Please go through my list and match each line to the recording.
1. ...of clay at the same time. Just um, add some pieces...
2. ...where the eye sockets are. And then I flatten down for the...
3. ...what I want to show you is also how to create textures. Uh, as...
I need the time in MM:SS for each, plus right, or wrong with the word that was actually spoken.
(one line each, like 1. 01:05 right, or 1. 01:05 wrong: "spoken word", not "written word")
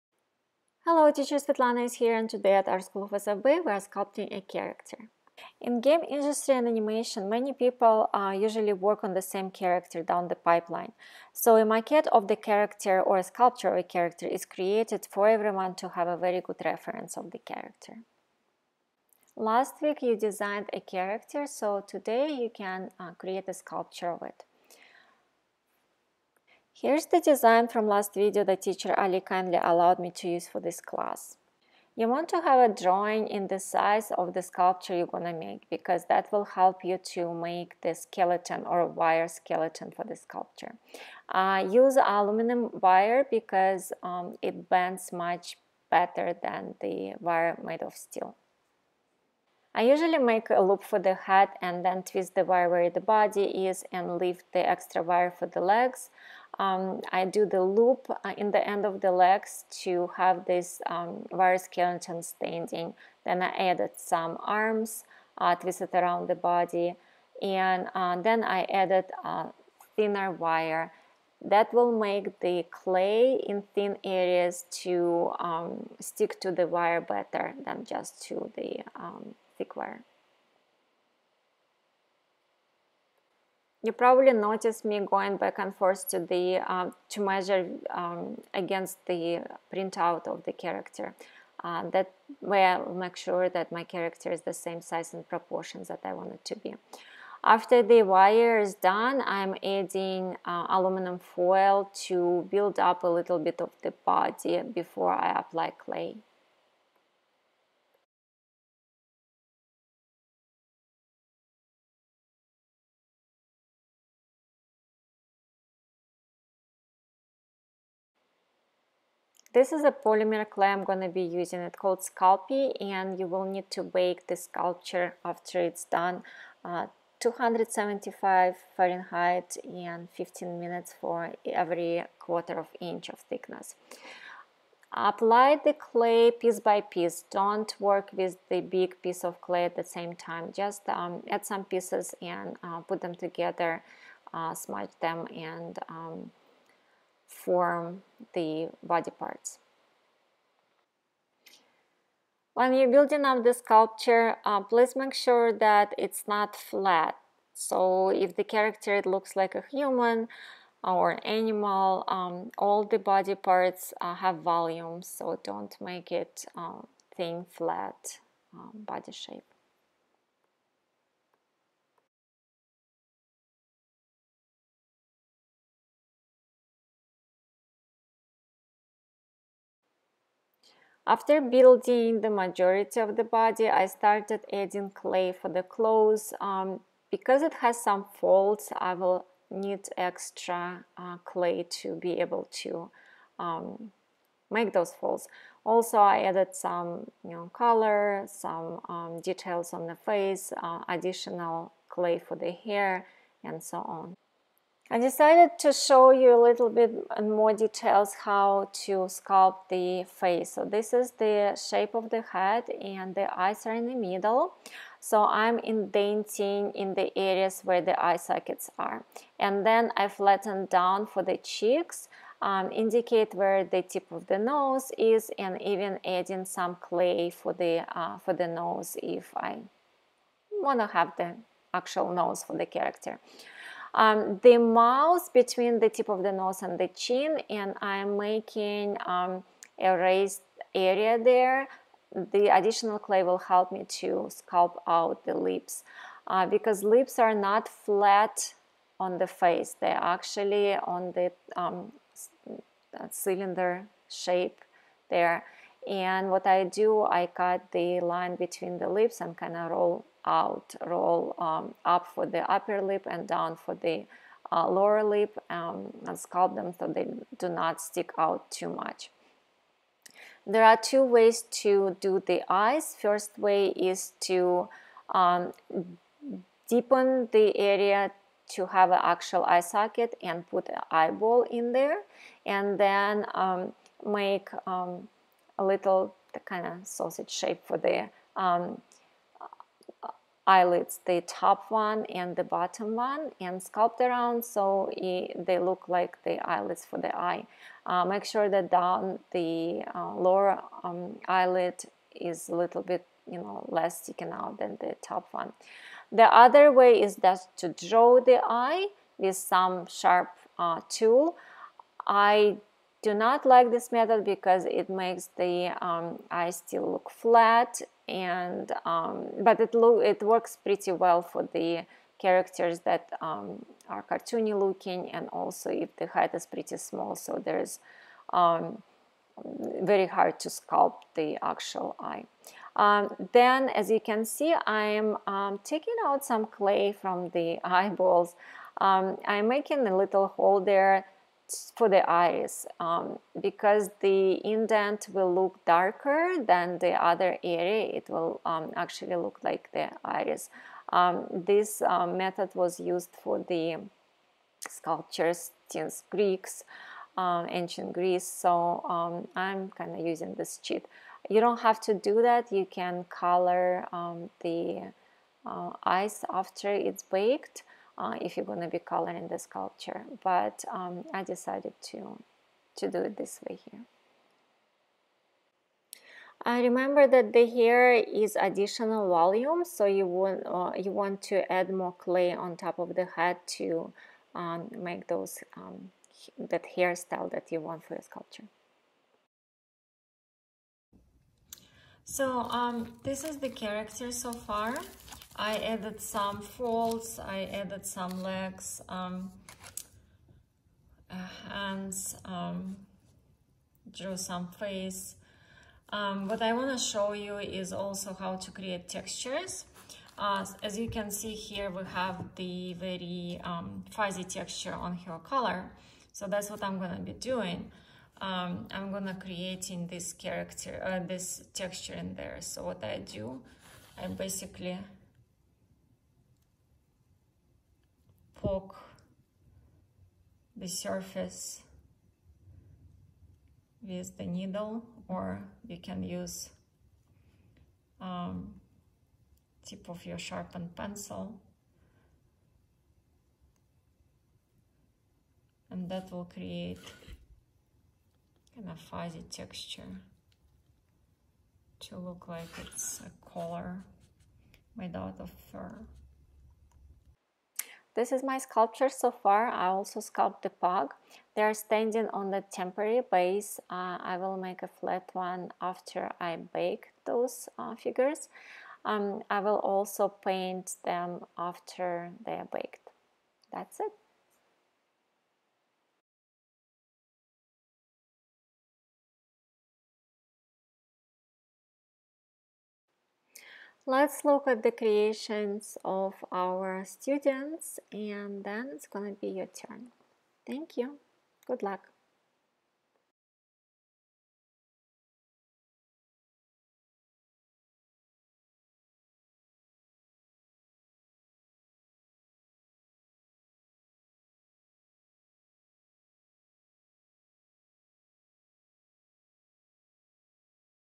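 1. 02:19 right
2. 03:37 right
3. 06:46 right.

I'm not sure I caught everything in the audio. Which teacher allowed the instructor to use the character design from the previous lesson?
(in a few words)
Ali.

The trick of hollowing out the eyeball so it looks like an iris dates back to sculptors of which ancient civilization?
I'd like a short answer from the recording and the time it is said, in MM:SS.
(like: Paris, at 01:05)
ancient Greece, at 05:57.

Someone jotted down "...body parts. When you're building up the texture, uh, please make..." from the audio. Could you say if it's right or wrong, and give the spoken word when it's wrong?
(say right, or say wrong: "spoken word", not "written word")
wrong: "sculpture", not "texture".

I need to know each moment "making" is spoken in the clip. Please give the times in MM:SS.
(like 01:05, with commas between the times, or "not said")
03:58, 05:39.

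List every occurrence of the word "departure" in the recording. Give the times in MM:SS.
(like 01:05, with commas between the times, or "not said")
not said.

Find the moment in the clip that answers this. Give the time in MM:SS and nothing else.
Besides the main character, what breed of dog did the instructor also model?
07:40.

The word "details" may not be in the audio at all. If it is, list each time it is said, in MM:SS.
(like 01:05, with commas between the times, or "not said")
03:19, 03:27.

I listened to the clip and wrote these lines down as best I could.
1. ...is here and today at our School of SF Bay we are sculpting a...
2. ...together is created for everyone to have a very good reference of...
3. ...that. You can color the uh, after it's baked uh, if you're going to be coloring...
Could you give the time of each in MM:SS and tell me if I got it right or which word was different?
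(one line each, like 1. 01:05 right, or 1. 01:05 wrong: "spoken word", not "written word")
1. 00:01 right
2. 00:13 wrong: "character", not "together"
3. 06:02 right.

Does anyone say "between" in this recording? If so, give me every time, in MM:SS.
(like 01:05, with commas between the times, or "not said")
03:55, 04:18.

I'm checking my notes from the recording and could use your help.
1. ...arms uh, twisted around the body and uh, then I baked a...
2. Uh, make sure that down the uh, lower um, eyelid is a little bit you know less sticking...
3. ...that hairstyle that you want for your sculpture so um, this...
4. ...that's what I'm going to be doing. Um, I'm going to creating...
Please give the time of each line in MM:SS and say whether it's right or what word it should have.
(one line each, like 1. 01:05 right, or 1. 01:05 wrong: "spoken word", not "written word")
1. 01:04 wrong: "added", not "baked"
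2. 04:57 right
3. 06:26 right
4. 06:56 right.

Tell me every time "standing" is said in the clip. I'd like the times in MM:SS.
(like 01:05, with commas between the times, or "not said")
01:02, 07:41.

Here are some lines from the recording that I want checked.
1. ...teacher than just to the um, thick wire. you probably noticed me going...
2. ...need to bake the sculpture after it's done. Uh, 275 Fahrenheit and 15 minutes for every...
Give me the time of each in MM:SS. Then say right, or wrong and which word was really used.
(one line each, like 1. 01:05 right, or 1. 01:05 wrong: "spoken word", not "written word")
1. 01:17 wrong: "better", not "teacher"
2. 02:03 right.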